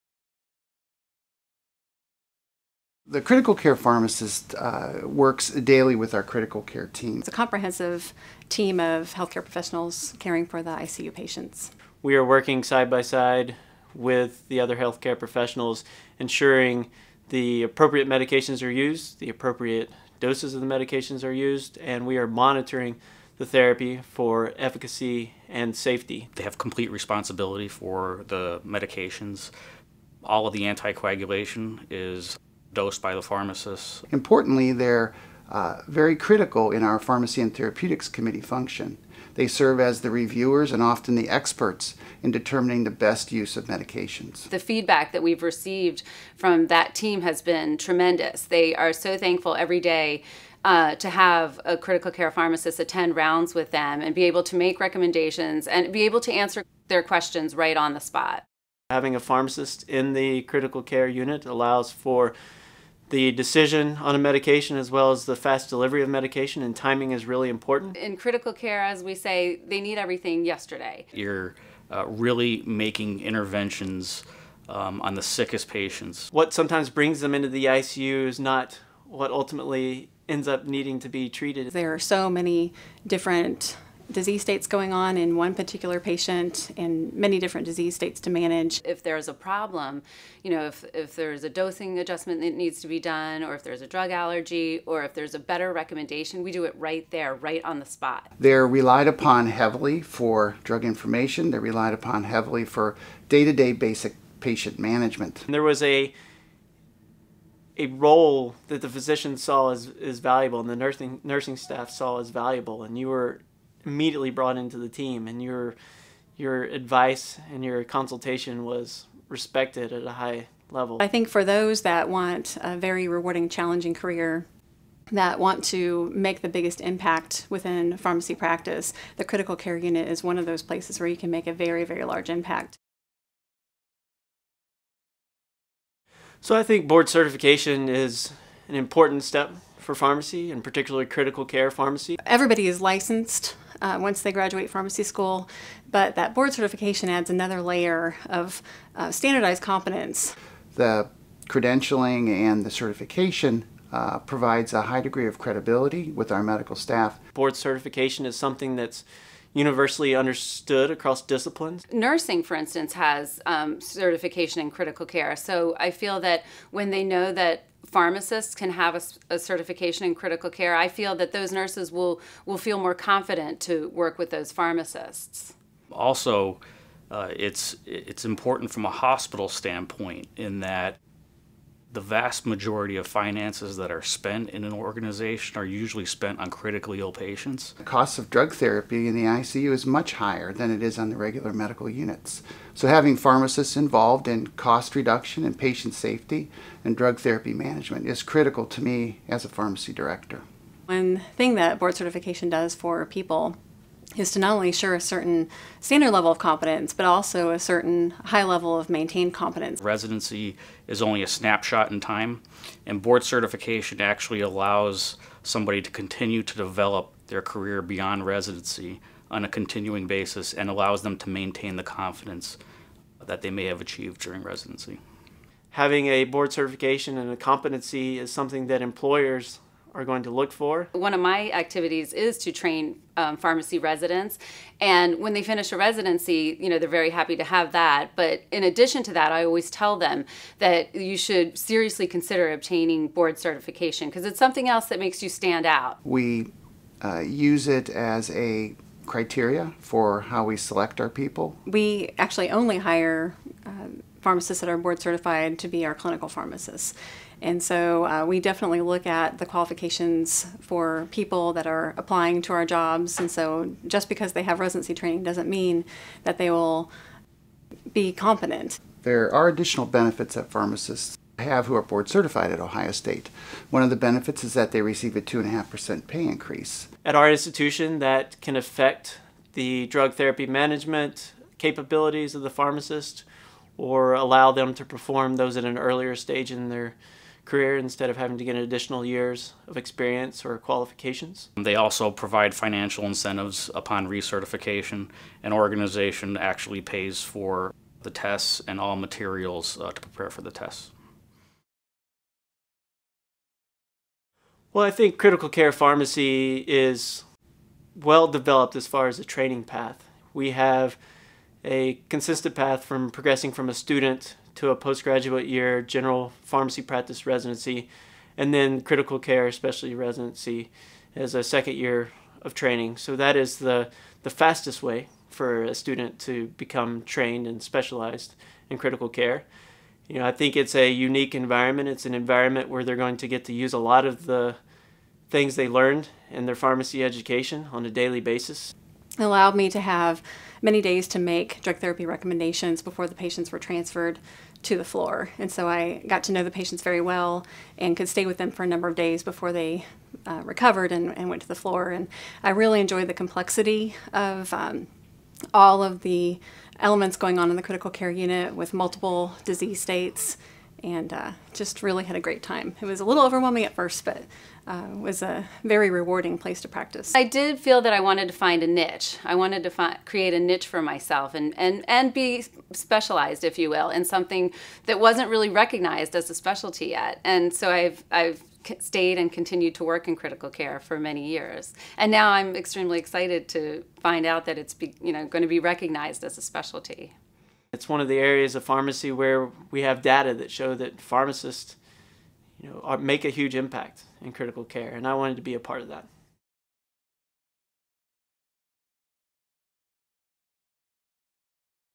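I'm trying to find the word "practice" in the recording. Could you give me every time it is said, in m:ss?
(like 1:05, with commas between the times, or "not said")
2:08, 5:16, 6:06.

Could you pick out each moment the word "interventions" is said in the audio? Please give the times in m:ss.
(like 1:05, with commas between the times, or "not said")
1:13.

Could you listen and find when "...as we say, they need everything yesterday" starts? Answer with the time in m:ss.
1:08.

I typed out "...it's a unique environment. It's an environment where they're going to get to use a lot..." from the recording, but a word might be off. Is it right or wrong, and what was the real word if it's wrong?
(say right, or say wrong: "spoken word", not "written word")
right.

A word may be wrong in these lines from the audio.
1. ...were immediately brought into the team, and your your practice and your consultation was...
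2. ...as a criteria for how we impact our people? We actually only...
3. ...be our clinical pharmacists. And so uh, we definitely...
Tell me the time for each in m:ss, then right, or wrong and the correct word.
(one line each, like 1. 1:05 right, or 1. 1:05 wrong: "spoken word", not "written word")
1. 1:53 wrong: "advice", not "practice"
2. 4:07 wrong: "select", not "impact"
3. 4:15 right.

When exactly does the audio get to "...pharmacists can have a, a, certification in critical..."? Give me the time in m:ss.
2:47.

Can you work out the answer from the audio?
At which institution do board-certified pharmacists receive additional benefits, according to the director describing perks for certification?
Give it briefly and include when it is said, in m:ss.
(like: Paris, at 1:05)
Ohio State, at 4:32.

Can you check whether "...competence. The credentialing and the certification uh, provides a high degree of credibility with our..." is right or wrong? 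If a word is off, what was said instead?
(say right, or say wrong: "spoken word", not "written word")
right.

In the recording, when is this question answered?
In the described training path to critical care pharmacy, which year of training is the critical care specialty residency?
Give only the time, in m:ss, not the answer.
5:21.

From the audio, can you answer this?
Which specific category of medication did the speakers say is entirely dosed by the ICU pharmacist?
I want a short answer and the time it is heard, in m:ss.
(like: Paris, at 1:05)
anticoagulation, at 0:30.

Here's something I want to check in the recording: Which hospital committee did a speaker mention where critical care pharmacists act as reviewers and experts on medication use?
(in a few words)
Pharmacy and Therapeutics Committee.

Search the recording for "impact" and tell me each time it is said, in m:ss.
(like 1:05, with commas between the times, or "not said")
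2:06, 2:12, 6:33.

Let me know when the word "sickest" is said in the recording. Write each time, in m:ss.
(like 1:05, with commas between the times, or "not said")
1:15.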